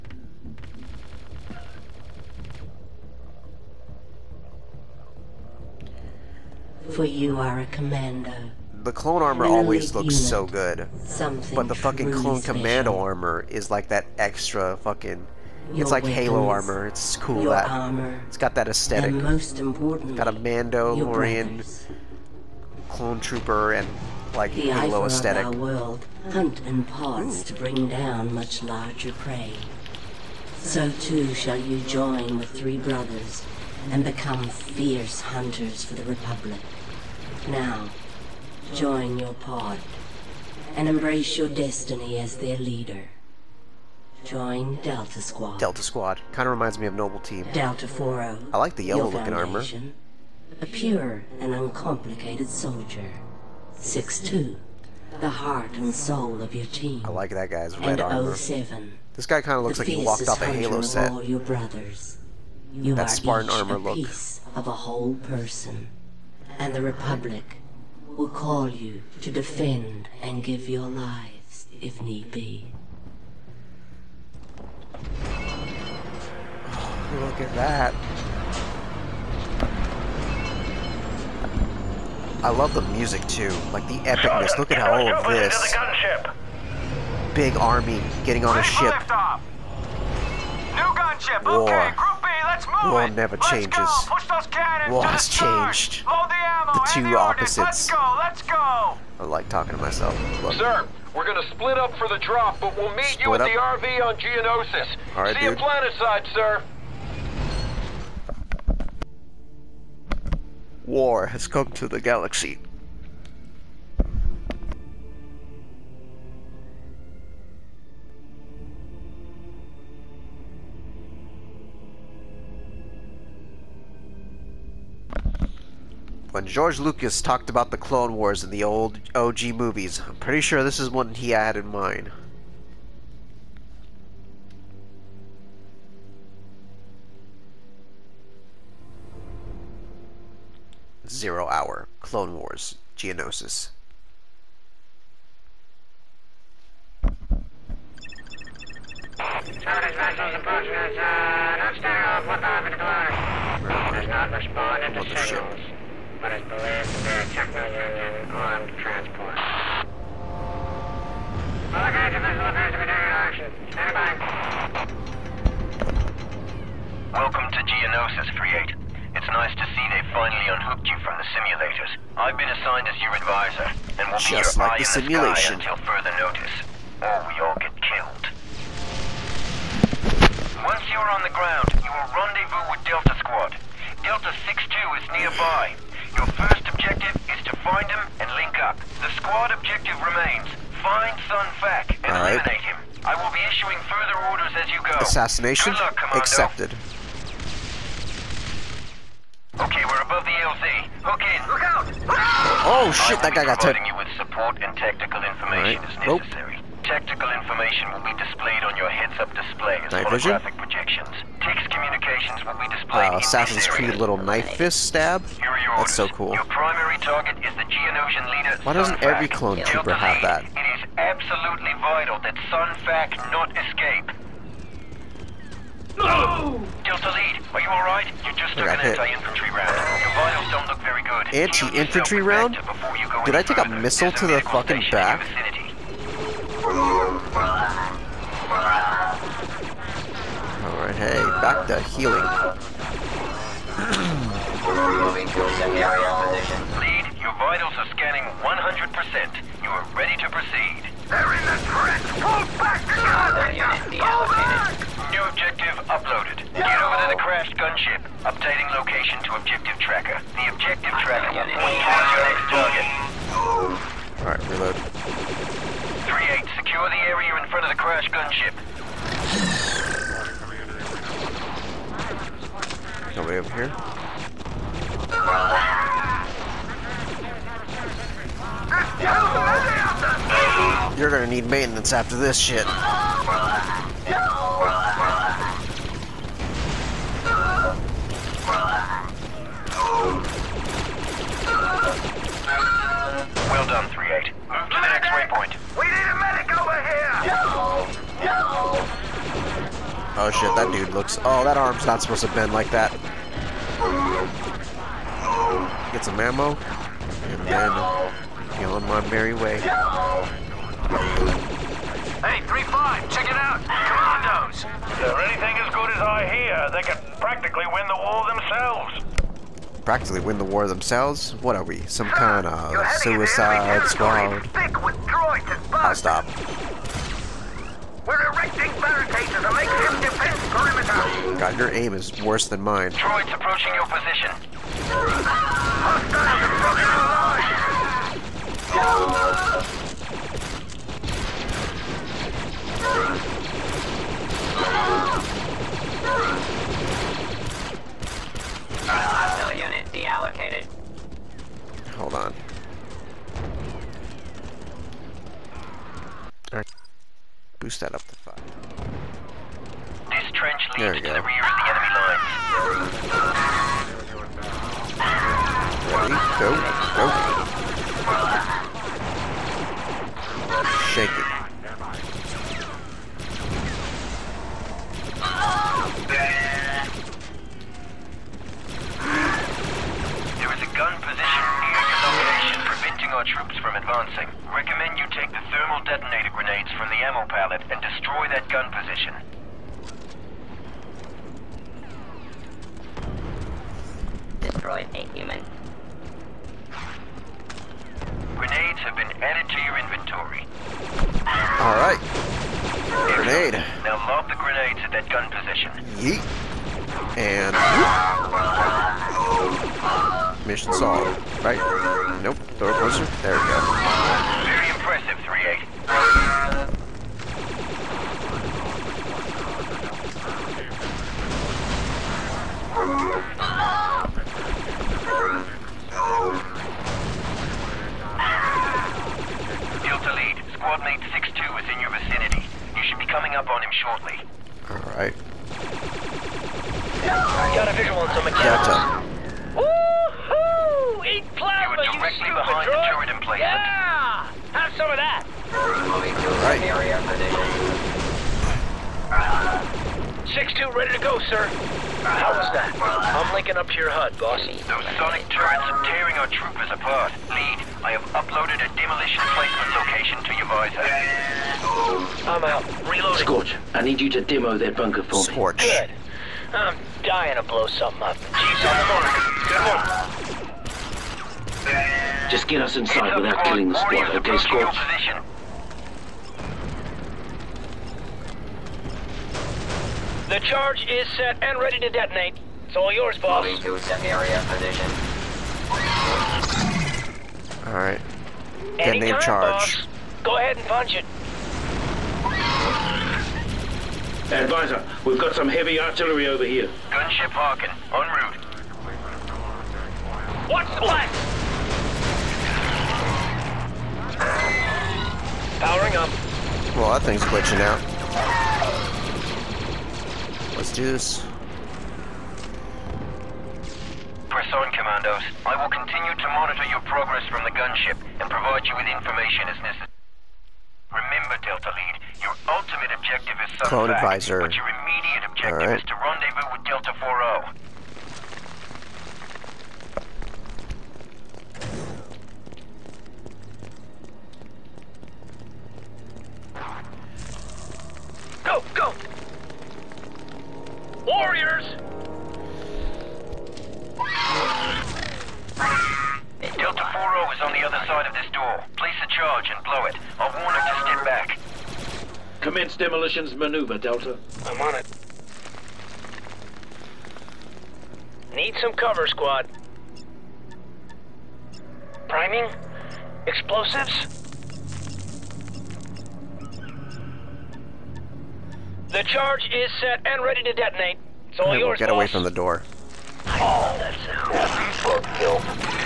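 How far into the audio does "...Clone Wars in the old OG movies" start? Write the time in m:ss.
2:07.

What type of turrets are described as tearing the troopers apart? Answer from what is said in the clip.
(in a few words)
sonic turrets.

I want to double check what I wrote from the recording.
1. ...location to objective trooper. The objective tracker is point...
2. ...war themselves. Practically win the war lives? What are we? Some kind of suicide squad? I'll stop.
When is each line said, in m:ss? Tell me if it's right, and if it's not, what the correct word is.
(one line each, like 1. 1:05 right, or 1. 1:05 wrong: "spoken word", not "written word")
1. 4:18 wrong: "tracker", not "trooper"
2. 5:17 wrong: "themselves", not "lives".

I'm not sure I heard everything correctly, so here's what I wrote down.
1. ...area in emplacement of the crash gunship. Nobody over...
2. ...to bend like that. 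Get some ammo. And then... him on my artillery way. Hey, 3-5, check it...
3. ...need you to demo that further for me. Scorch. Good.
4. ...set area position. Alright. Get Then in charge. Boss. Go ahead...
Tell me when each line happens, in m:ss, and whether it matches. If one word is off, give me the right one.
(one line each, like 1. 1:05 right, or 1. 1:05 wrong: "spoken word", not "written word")
1. 4:27 wrong: "front", not "emplacement"
2. 5:02 wrong: "merry", not "artillery"
3. 7:43 wrong: "bunker", not "further"
4. 8:03 right.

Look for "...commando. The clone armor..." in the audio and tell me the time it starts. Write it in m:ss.
0:07.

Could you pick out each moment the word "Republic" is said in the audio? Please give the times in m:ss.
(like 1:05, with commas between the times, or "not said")
0:36, 1:06.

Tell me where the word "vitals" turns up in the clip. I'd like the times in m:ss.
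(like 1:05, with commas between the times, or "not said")
3:41, 3:50, 4:07.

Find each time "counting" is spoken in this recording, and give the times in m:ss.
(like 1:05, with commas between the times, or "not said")
not said.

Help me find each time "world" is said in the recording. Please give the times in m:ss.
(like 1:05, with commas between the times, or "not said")
0:25.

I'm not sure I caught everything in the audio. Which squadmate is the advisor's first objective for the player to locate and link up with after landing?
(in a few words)
Delta 6-2.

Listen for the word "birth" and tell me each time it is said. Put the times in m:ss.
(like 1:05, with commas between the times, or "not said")
not said.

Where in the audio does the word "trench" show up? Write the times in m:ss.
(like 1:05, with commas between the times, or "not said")
4:11, 6:00.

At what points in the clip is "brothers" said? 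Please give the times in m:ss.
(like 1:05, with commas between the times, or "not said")
0:32, 1:01.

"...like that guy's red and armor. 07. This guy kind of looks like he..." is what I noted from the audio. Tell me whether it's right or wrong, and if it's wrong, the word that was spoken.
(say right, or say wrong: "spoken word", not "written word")
right.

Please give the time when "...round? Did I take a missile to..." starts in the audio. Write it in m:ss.
3:52.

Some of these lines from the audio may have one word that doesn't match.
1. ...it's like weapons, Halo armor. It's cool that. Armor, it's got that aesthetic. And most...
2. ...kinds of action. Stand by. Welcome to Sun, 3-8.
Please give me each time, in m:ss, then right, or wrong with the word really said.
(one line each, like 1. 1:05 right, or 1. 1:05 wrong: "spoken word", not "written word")
1. 0:15 right
2. 2:41 wrong: "Geonosis", not "Sun".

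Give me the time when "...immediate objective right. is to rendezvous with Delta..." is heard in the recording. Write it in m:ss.
8:44.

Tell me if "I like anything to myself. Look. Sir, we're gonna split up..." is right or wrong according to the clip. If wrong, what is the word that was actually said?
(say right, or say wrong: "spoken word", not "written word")
wrong: "talking", not "anything".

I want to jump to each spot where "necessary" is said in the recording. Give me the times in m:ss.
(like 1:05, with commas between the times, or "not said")
3:25, 8:39.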